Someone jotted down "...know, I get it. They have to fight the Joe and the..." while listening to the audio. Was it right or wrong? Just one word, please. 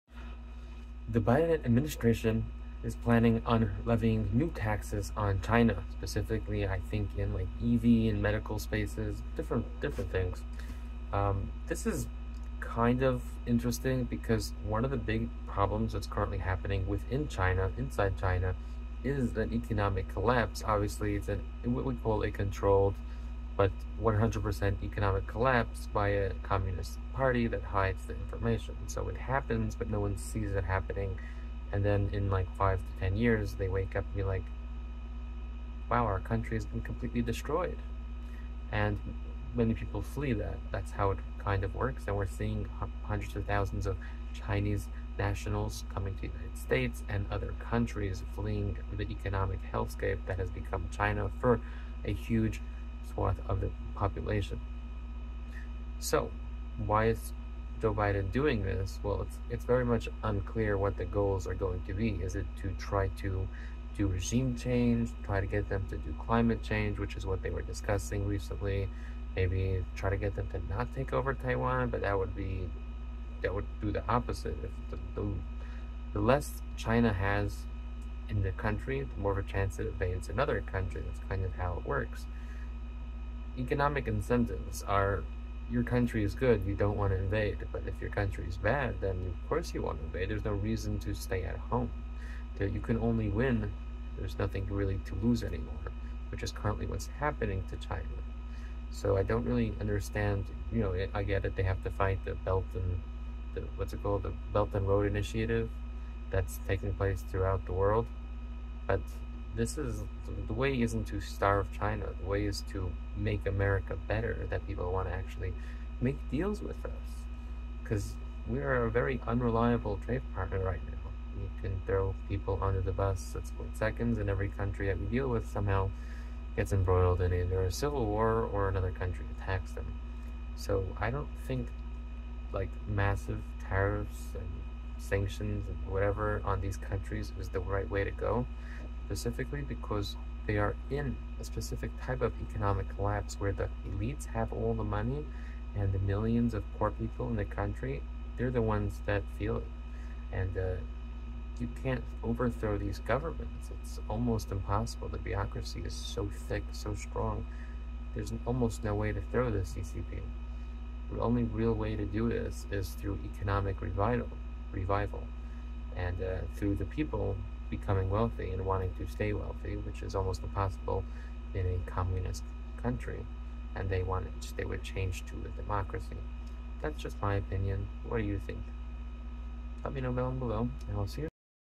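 wrong.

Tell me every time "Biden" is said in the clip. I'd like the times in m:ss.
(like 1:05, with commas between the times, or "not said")
0:01, 0:57.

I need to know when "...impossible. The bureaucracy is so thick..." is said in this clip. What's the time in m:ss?
2:34.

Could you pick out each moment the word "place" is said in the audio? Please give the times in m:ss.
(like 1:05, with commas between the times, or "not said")
1:46.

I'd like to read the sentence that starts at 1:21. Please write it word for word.
That's kind of how it works economic incentives are your country is good, you don't want to invade.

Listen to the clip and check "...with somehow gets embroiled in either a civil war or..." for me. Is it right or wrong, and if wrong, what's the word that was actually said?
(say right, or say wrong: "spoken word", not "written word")
right.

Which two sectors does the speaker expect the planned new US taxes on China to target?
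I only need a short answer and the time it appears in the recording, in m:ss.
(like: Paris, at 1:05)
EV and medical, at 0:07.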